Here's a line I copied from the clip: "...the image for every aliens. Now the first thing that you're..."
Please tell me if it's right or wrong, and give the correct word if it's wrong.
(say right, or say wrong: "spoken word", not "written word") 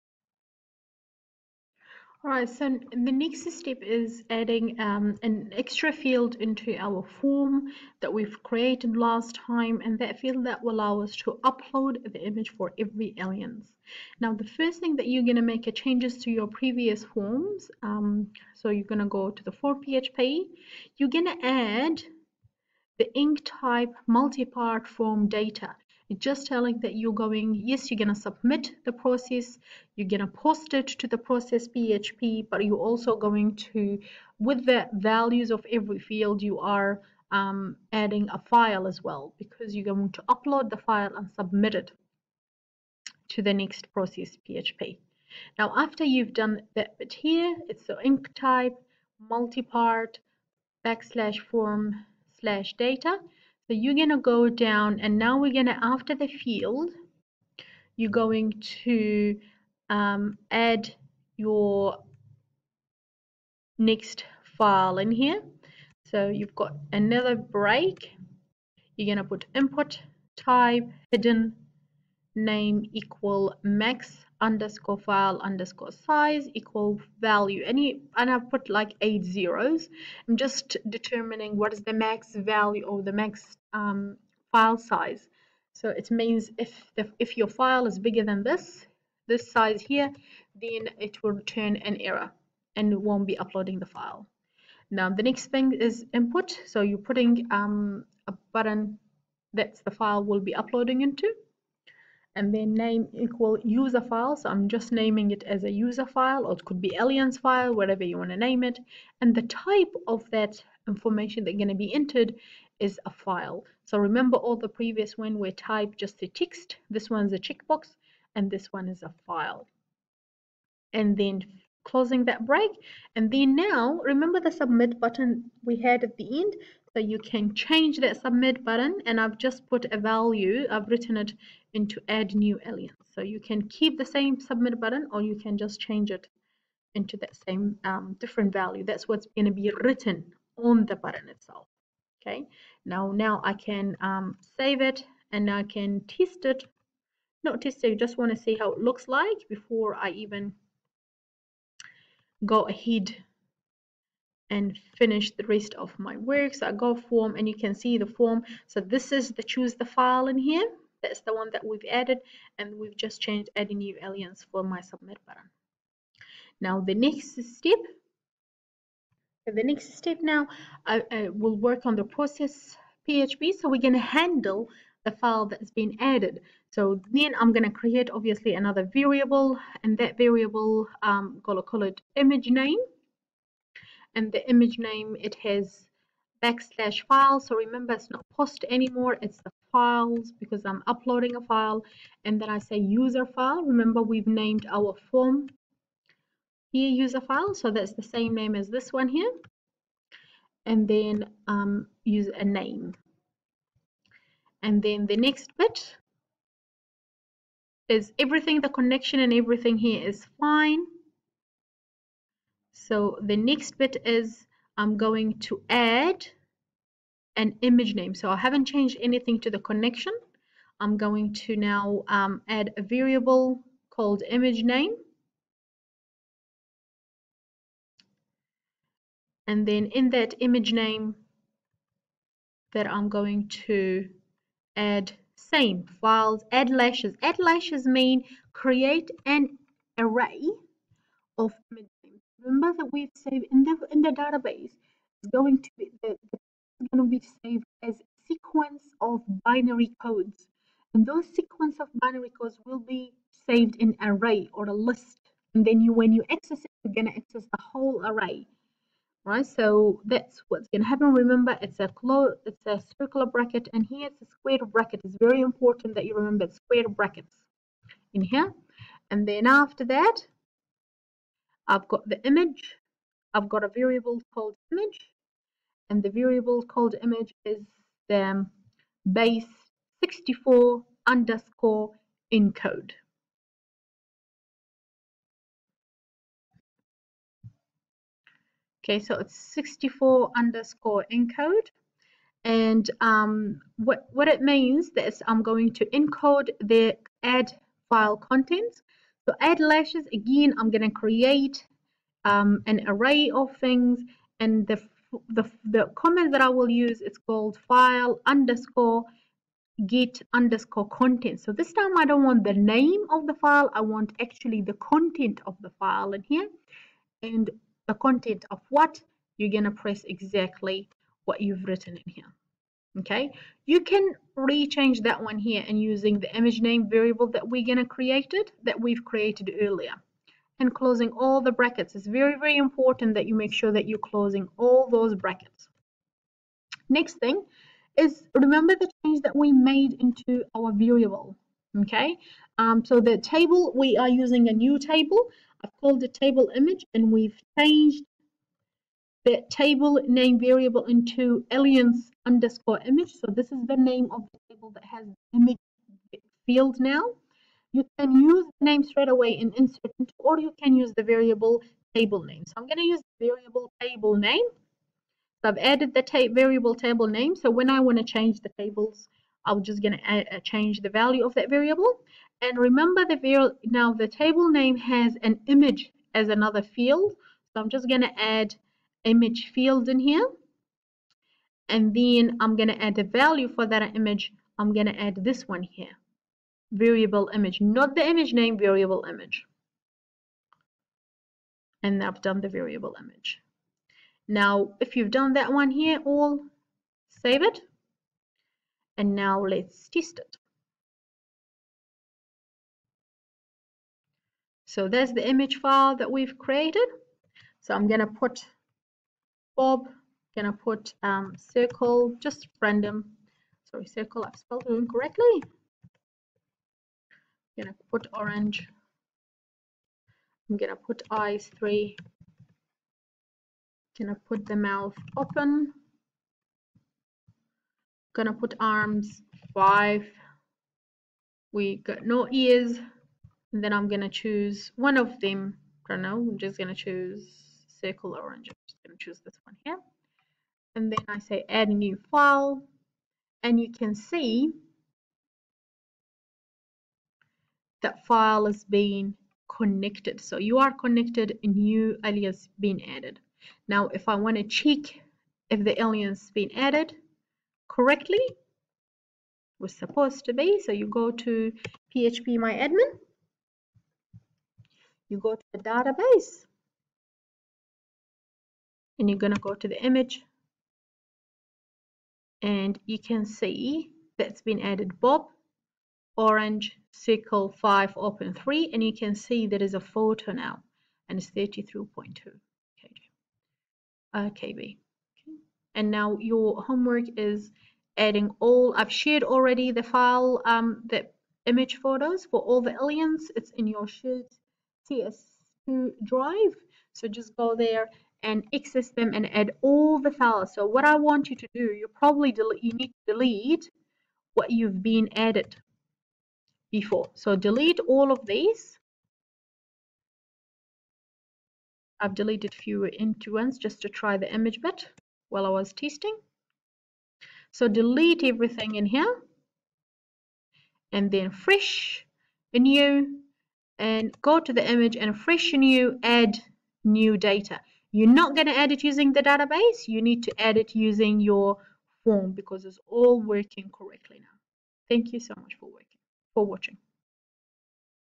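right.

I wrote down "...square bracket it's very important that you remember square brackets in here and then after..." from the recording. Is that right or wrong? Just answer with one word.
right.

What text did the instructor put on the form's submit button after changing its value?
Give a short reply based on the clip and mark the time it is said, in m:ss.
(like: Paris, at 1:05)
add new alien, at 2:12.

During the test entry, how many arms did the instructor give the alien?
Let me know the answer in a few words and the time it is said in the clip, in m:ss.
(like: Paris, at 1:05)
5, at 7:09.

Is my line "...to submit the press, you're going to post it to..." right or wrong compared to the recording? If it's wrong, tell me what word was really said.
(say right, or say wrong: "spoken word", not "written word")
wrong: "process", not "press".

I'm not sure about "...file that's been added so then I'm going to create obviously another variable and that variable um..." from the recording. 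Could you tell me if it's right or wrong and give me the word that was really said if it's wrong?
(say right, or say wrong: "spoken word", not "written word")
right.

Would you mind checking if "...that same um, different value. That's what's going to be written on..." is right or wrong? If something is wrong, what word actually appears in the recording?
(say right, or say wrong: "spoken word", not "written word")
right.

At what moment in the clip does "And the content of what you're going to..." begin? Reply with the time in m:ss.
5:17.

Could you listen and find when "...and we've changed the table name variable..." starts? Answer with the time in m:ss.
5:46.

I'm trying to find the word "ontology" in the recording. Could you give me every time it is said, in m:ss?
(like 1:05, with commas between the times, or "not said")
not said.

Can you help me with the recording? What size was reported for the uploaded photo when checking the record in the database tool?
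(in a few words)
33.2 KB.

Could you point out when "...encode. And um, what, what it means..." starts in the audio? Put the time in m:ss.
4:51.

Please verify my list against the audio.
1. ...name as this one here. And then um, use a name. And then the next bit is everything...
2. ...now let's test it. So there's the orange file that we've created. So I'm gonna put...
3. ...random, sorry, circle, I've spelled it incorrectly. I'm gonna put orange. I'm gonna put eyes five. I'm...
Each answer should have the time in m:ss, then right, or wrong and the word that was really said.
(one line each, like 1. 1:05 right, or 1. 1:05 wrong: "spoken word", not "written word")
1. 3:18 right
2. 6:39 wrong: "image", not "orange"
3. 6:52 wrong: "three", not "five".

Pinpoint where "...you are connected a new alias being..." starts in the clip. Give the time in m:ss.
7:30.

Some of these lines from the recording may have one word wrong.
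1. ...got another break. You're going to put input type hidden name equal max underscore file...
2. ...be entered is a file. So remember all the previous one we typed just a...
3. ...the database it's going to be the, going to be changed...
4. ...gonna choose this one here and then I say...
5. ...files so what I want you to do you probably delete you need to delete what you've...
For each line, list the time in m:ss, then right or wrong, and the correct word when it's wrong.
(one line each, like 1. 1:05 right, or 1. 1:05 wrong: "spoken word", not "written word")
1. 1:06 right
2. 1:51 right
3. 4:04 wrong: "saved", not "changed"
4. 7:18 right
5. 8:20 right.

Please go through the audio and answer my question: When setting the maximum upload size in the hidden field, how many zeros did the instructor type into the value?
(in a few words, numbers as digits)
8.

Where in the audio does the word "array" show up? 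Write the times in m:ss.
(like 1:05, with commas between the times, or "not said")
3:59, 4:14, 4:18, 5:02.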